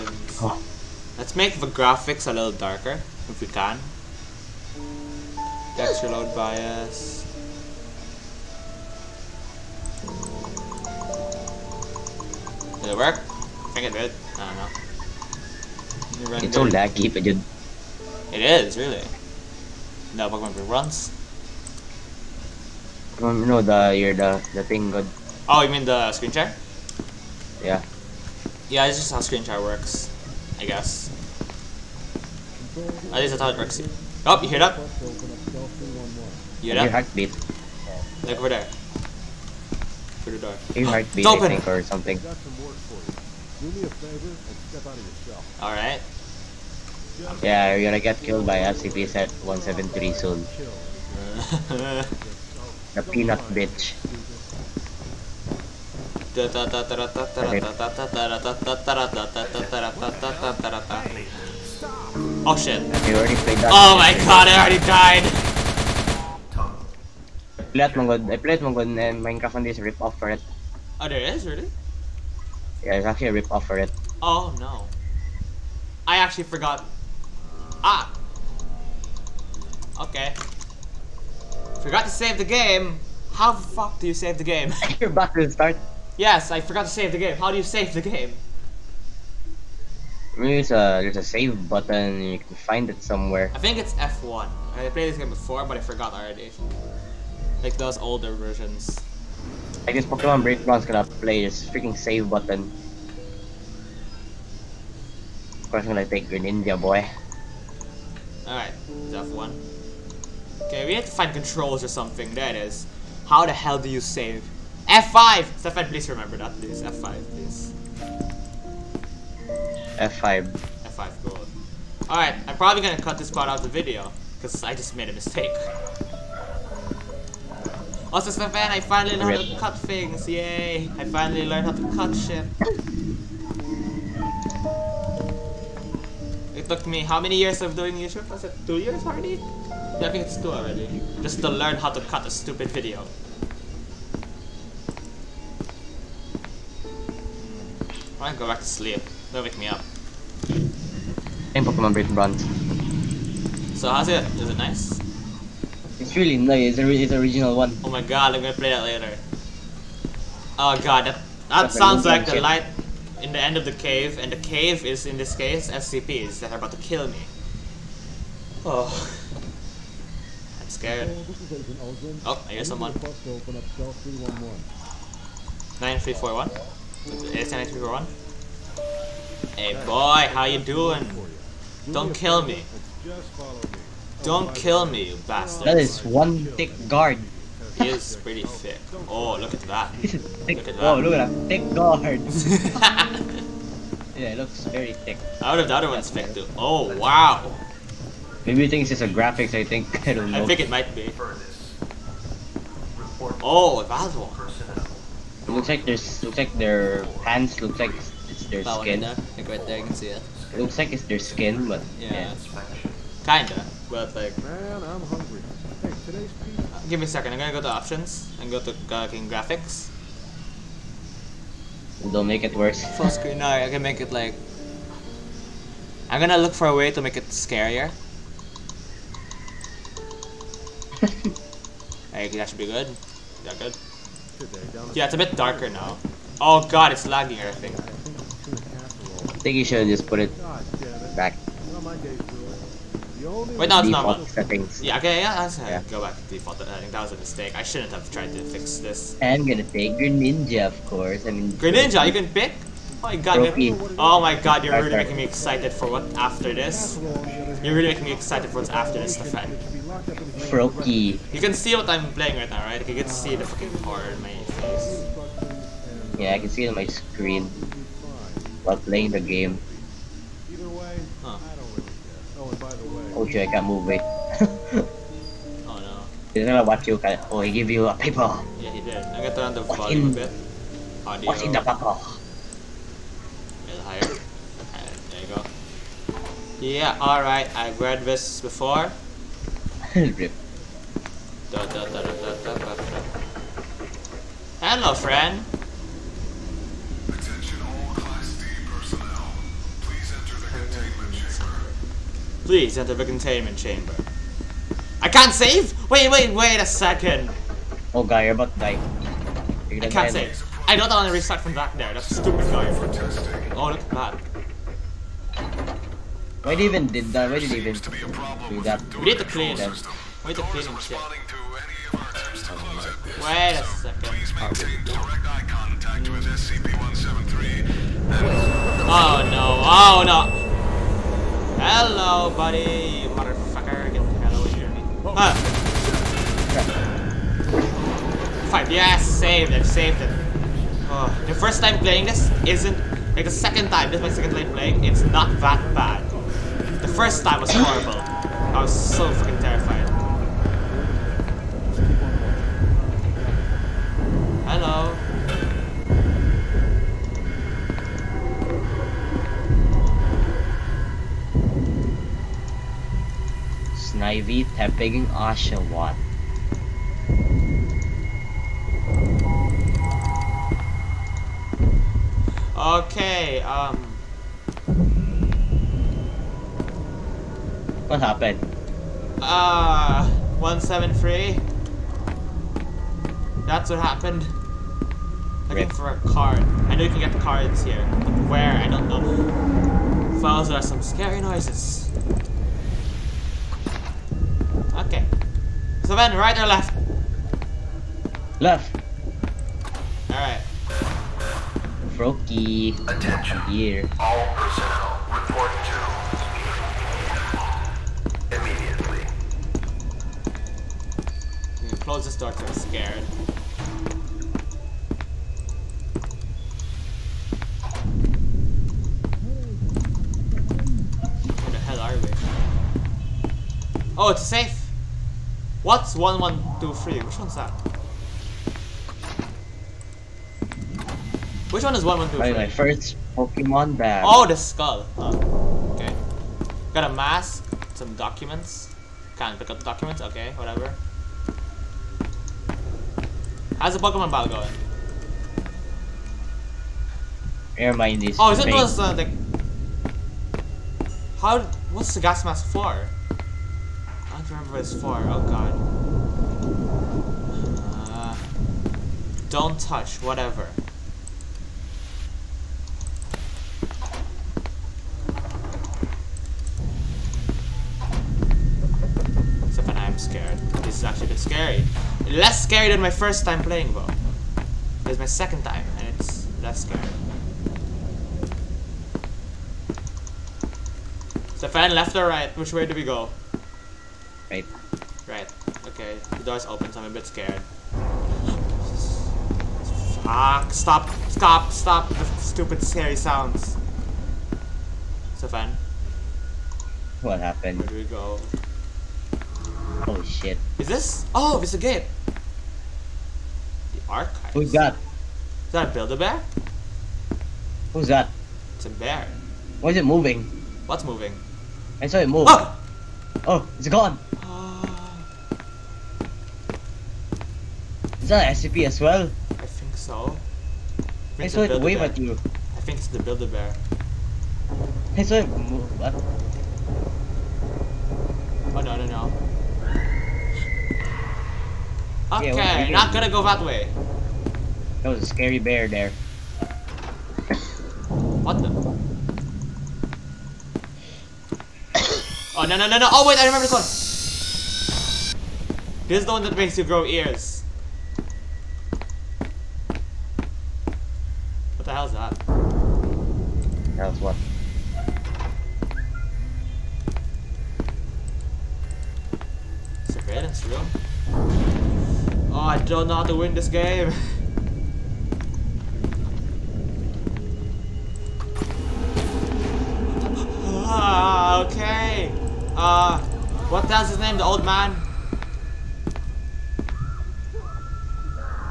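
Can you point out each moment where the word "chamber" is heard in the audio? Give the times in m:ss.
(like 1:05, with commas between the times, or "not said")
5:03.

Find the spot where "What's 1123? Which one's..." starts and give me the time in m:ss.
7:05.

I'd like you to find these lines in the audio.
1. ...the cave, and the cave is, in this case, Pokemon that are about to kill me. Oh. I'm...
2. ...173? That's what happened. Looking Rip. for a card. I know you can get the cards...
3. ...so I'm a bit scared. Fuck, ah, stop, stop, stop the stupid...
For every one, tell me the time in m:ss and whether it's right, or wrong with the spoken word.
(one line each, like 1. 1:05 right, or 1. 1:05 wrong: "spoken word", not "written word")
1. 2:43 wrong: "SCPs", not "Pokemon"
2. 6:20 right
3. 8:06 right.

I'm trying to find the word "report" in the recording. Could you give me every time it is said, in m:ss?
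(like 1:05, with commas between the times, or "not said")
6:45.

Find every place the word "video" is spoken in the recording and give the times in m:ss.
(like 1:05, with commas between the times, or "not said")
2:03, 2:22.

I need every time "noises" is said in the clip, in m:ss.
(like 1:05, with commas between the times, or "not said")
6:31.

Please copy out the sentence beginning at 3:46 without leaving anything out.
I'm gonna look for a way to make it scarier.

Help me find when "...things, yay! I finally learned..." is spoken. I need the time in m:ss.
2:09.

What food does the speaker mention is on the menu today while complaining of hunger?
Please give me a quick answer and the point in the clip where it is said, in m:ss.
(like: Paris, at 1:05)
Pizza, at 3:36.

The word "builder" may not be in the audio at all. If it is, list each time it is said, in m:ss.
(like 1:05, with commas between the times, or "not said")
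8:25, 8:43.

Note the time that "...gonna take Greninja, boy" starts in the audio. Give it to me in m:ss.
1:45.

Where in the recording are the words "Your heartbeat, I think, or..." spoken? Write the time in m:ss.
0:40.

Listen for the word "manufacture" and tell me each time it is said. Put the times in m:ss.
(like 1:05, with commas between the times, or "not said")
not said.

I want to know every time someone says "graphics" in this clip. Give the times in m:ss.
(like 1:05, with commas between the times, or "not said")
0:01, 3:19, 3:38.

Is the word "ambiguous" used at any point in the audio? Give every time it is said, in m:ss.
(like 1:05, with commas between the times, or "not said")
not said.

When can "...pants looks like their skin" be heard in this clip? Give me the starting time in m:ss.
3:27.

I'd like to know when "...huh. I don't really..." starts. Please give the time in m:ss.
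4:31.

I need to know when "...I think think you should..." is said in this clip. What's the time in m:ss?
3:57.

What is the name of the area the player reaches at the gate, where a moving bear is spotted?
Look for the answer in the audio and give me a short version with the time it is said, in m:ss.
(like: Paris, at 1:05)
The archive, at 8:23.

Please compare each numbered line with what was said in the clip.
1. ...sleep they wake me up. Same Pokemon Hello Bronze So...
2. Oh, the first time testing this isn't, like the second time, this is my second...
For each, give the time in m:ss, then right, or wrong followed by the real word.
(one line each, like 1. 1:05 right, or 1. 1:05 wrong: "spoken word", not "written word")
1. 2:28 wrong: "Brick", not "Hello"
2. 5:40 wrong: "playing", not "testing".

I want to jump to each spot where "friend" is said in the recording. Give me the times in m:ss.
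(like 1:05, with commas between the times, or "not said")
4:54.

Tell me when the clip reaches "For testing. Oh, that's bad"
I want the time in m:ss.
5:12.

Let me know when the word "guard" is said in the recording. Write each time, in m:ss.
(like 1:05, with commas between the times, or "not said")
3:06, 3:11.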